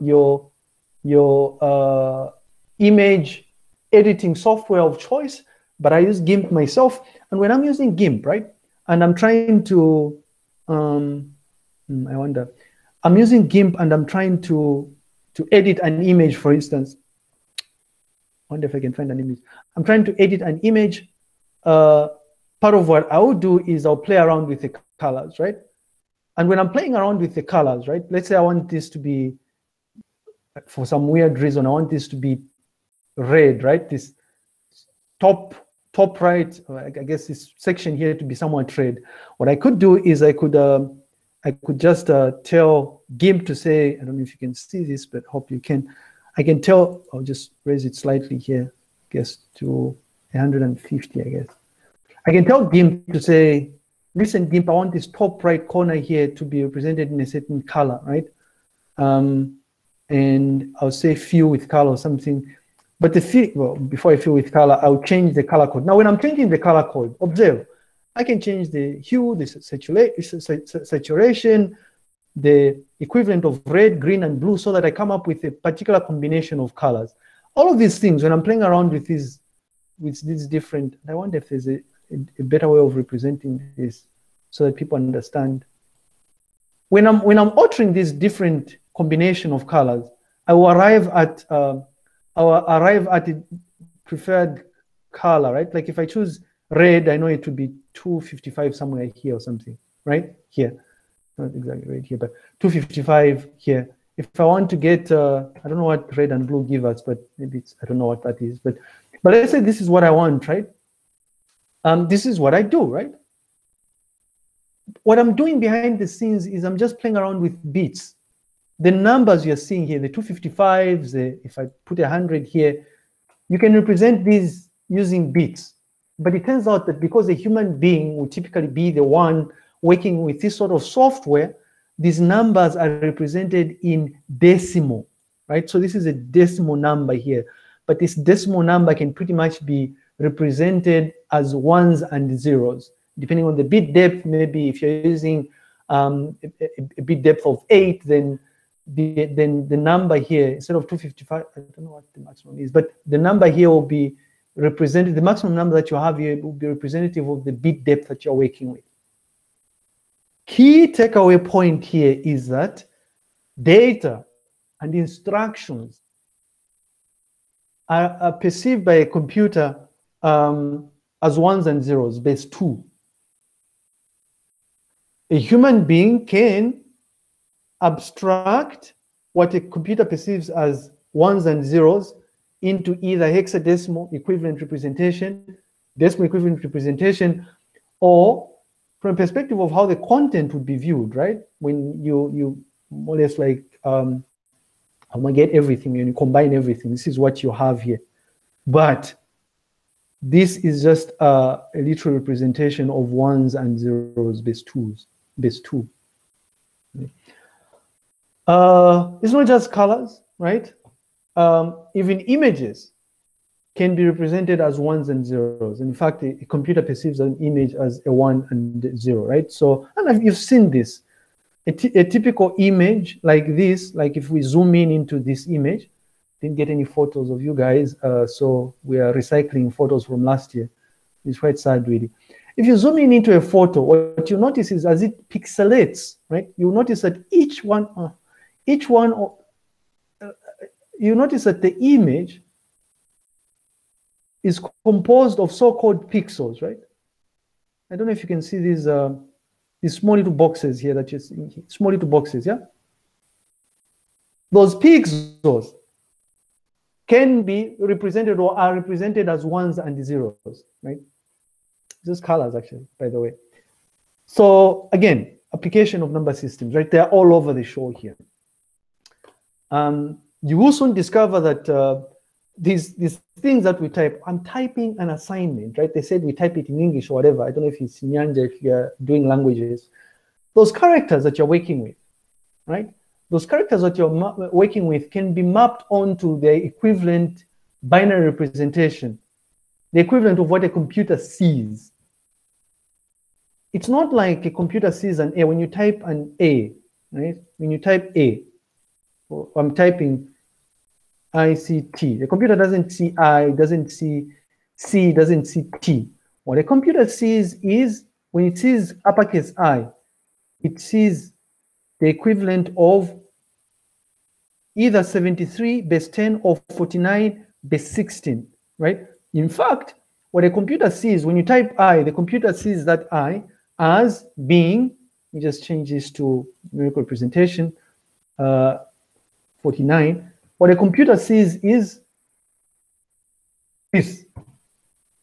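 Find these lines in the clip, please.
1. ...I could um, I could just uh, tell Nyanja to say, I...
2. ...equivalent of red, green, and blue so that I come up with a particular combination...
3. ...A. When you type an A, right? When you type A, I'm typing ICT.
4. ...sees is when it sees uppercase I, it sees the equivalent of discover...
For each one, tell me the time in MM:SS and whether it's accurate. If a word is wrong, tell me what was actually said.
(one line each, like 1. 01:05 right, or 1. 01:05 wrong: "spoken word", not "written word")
1. 00:40 wrong: "GIMP", not "Nyanja"
2. 01:12 right
3. 04:55 right
4. 05:07 wrong: "either", not "discover".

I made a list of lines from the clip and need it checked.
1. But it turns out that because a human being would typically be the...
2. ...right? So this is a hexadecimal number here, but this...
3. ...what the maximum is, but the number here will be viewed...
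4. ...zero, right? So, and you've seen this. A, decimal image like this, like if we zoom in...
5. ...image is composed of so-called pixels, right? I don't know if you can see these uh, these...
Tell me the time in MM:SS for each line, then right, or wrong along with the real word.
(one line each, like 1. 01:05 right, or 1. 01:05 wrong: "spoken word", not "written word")
1. 02:06 right
2. 02:15 wrong: "decimal", not "hexadecimal"
3. 02:31 wrong: "represented", not "viewed"
4. 03:38 wrong: "typical", not "decimal"
5. 04:01 right.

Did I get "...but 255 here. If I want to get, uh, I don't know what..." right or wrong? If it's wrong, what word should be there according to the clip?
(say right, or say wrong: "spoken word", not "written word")
right.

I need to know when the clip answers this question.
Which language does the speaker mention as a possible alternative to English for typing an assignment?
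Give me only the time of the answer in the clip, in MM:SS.
04:37.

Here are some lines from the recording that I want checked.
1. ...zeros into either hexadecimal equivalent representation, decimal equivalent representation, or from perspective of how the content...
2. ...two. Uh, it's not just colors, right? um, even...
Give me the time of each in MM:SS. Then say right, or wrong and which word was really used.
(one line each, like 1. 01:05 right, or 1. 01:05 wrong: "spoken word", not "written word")
1. 03:01 right
2. 03:25 right.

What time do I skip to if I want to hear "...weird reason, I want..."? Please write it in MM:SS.
00:31.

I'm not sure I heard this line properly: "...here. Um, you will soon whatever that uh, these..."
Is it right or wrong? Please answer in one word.
wrong.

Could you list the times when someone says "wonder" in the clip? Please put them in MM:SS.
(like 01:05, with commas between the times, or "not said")
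00:12, 00:18, 01:21.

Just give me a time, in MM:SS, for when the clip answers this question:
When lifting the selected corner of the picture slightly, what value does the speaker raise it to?
00:50.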